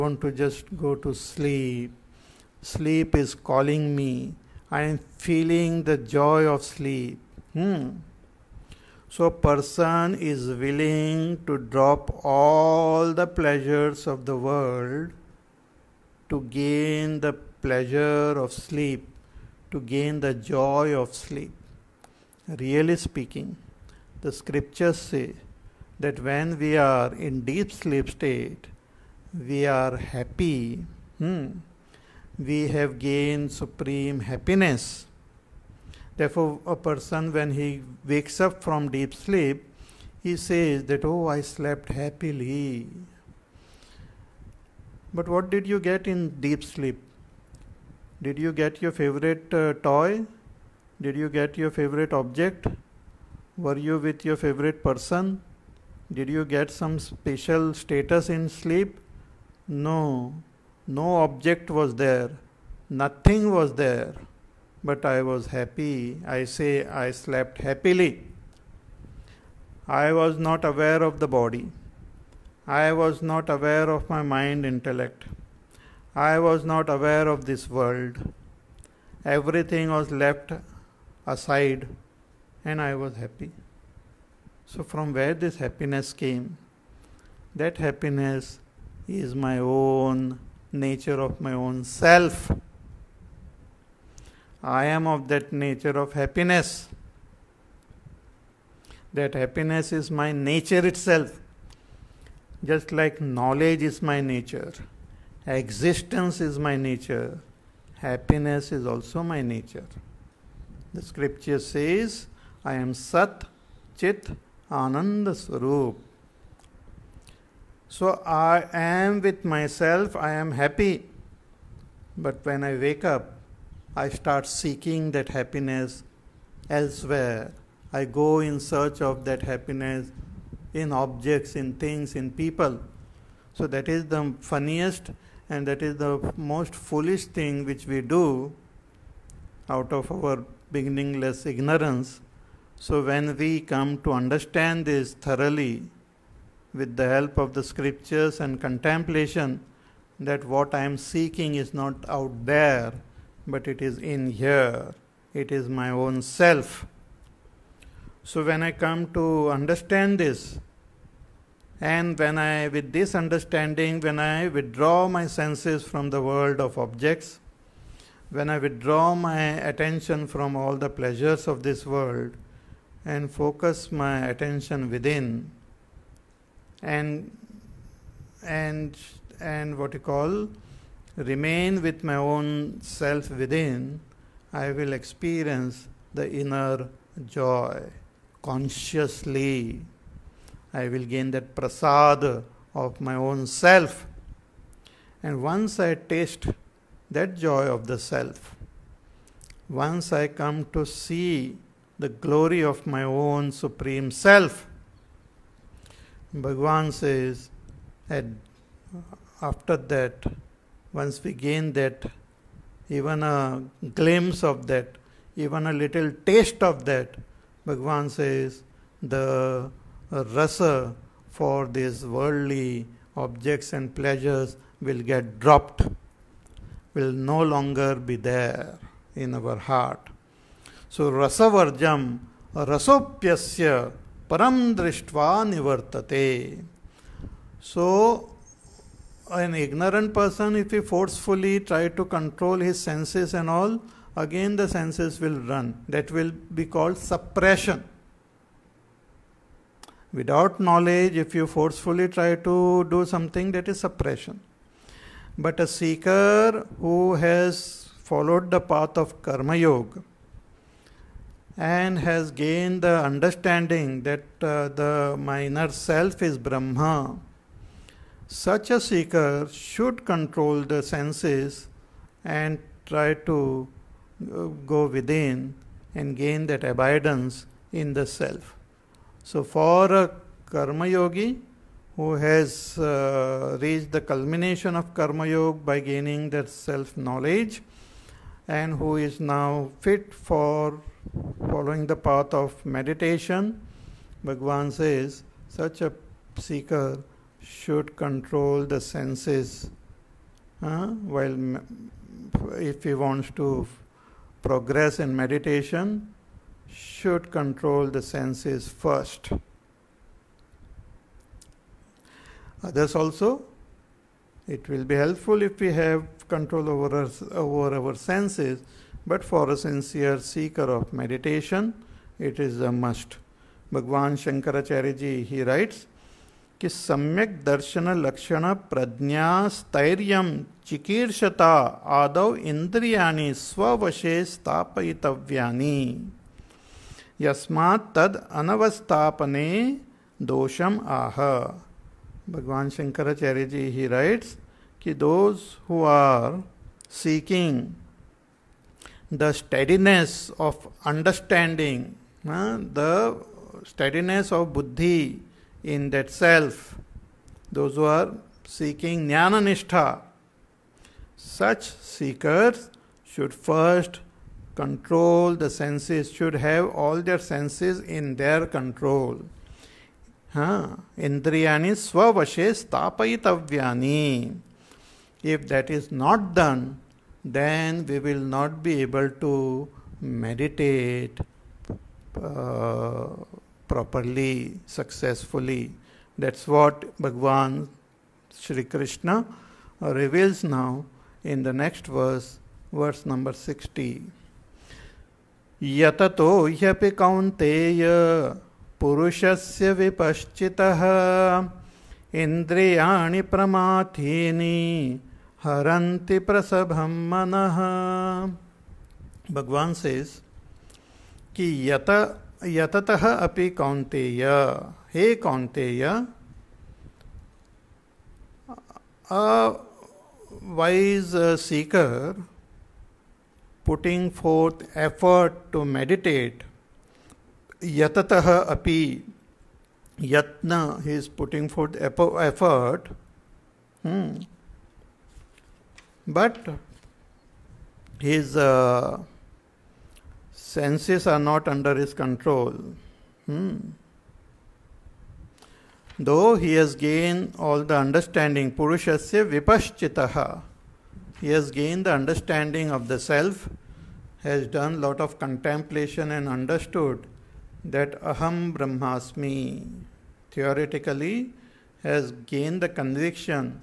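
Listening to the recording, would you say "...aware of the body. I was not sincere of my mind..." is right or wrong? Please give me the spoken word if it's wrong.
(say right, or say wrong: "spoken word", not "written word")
wrong: "aware", not "sincere".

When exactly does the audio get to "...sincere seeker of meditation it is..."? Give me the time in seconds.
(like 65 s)
319 s.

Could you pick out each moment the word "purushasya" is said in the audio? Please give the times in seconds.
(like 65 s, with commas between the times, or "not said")
398 s, 448 s.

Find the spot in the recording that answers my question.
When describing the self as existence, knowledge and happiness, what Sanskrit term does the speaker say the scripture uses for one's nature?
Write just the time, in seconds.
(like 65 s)
112 s.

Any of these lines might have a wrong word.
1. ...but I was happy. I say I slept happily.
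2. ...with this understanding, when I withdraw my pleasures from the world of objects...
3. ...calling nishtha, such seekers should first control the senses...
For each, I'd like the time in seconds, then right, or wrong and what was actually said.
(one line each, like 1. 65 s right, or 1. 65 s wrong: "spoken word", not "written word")
1. 64 s right
2. 162 s wrong: "senses", not "pleasures"
3. 358 s wrong: "seeking", not "calling".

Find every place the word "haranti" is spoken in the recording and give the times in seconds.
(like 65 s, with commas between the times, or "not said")
405 s.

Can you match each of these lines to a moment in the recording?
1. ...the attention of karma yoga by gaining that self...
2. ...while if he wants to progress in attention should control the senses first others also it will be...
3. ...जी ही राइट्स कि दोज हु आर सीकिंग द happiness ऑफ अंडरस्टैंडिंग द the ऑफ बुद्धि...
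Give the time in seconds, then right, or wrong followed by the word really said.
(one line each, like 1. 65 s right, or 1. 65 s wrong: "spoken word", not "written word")
1. 283 s wrong: "culmination", not "attention"
2. 301 s wrong: "meditation", not "attention"
3. 343 s wrong: "steadiness", not "happiness".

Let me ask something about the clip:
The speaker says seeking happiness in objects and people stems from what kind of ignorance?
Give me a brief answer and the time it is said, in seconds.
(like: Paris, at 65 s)
beginningless ignorance, at 140 s.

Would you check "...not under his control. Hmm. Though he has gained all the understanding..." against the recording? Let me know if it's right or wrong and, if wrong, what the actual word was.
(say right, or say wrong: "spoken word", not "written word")
right.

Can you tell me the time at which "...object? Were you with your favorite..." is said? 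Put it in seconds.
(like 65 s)
52 s.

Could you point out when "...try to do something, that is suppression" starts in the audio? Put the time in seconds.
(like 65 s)
252 s.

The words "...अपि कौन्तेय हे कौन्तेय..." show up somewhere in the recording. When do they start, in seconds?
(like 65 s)
413 s.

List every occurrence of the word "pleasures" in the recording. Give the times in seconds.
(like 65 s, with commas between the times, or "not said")
13 s, 17 s, 170 s, 223 s.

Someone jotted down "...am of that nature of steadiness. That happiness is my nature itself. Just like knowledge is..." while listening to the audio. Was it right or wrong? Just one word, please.
wrong.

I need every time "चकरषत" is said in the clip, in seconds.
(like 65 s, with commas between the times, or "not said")
330 s.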